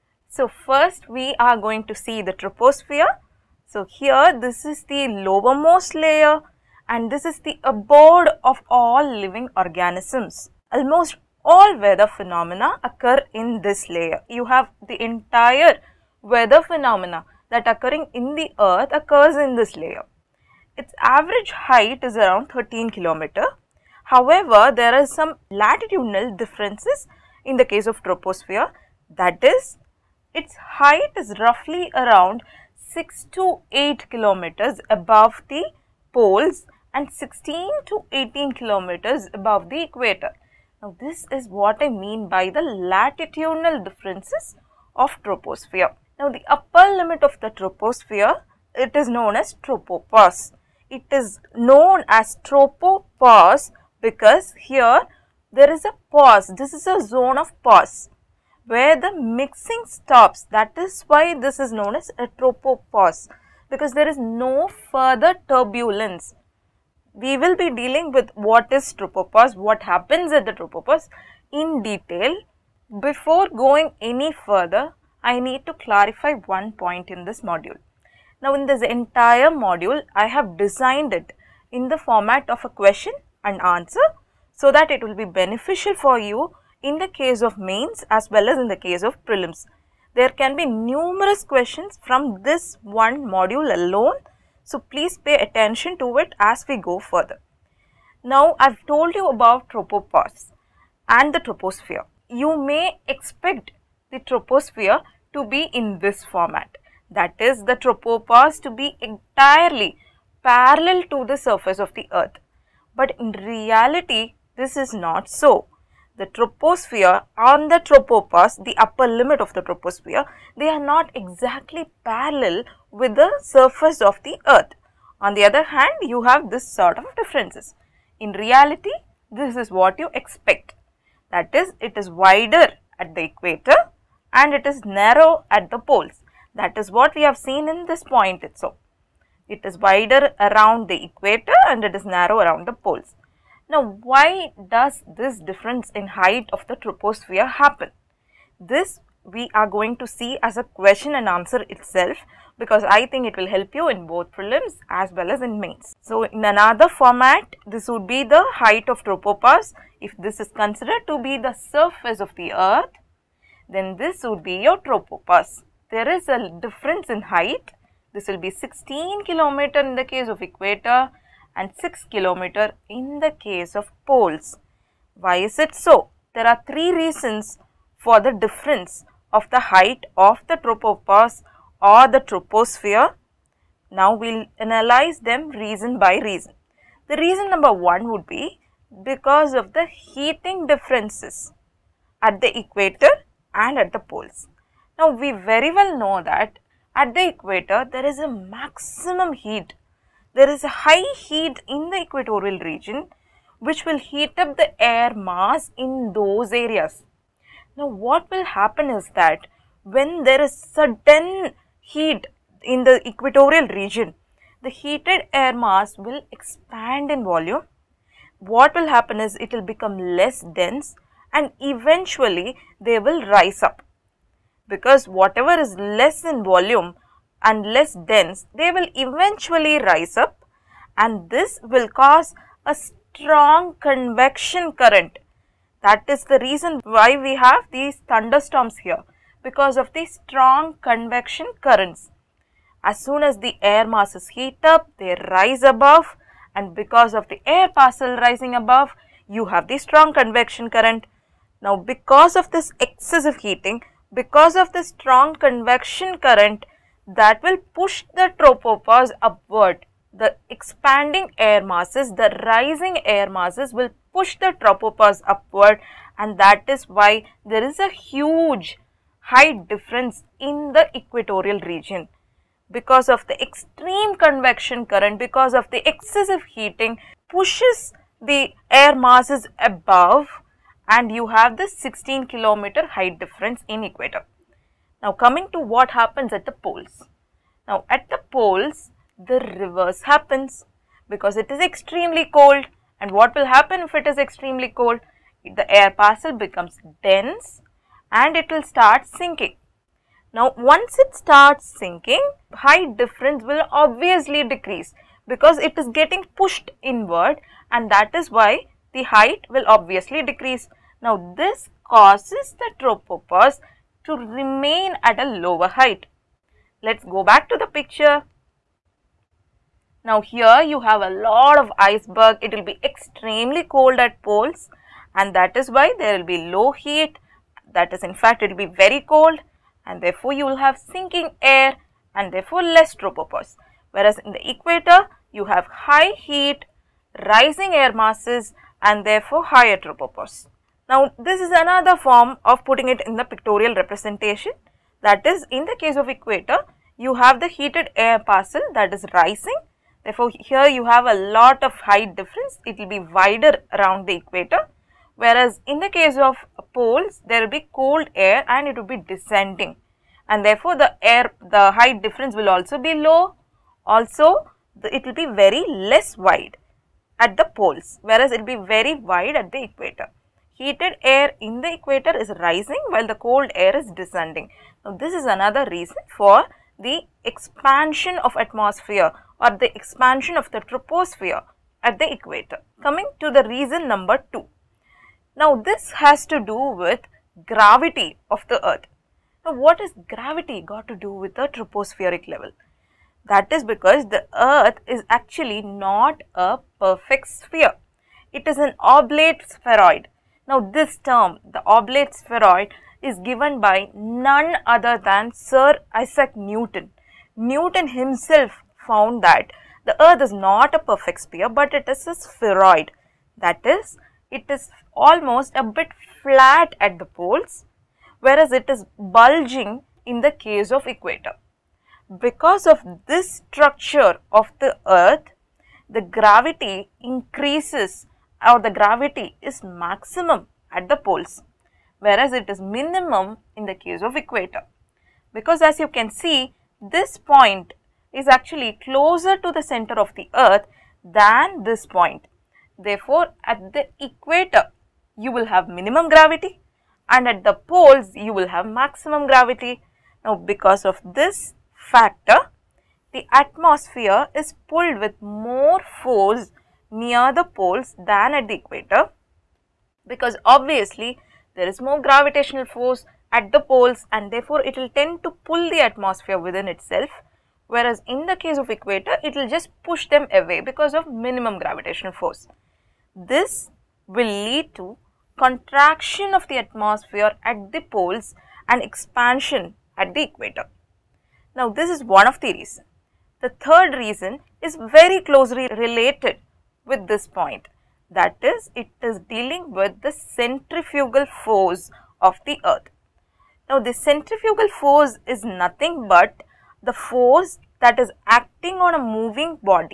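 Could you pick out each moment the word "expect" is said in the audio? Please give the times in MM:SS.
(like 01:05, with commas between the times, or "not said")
01:43, 02:10.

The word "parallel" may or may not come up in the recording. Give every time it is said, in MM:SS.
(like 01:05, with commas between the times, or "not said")
01:50, 02:02.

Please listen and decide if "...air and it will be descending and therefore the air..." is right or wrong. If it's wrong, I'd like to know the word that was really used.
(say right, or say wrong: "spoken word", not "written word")
right.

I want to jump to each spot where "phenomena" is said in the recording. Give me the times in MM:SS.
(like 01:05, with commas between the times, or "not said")
00:12, 00:16.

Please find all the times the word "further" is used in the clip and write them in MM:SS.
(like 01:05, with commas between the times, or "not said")
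01:04, 01:14, 01:36.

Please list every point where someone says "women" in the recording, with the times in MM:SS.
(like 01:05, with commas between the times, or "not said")
not said.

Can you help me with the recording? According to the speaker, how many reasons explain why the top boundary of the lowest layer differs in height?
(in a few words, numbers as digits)
3.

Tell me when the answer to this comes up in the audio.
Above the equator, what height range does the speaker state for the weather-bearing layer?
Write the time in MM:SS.
00:37.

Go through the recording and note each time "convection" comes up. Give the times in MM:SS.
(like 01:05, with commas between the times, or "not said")
03:53, 04:00, 04:10, 04:15, 04:34.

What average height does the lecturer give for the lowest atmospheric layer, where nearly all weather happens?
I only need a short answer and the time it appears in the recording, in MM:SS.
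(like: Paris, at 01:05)
13 km, at 00:22.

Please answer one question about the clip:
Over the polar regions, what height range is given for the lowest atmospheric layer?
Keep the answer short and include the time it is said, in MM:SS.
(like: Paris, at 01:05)
6 to 8 km, at 00:32.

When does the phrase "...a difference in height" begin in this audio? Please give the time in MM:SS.
02:46.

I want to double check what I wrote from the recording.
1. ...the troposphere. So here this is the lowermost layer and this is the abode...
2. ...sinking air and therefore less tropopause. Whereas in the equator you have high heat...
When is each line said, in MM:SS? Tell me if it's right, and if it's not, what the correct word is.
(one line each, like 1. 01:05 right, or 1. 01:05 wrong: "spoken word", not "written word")
1. 00:02 right
2. 05:30 right.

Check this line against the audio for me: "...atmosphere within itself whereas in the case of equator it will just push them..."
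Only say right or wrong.
right.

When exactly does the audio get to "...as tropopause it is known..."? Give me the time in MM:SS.
00:49.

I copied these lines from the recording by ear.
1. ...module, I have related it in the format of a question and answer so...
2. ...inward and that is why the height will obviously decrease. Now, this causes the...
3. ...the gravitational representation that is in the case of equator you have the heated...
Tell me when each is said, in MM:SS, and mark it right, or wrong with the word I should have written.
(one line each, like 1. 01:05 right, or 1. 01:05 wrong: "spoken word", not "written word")
1. 01:19 wrong: "designed", not "related"
2. 05:06 right
3. 05:43 wrong: "pictorial", not "gravitational".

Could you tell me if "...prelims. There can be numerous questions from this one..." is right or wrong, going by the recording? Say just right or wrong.
right.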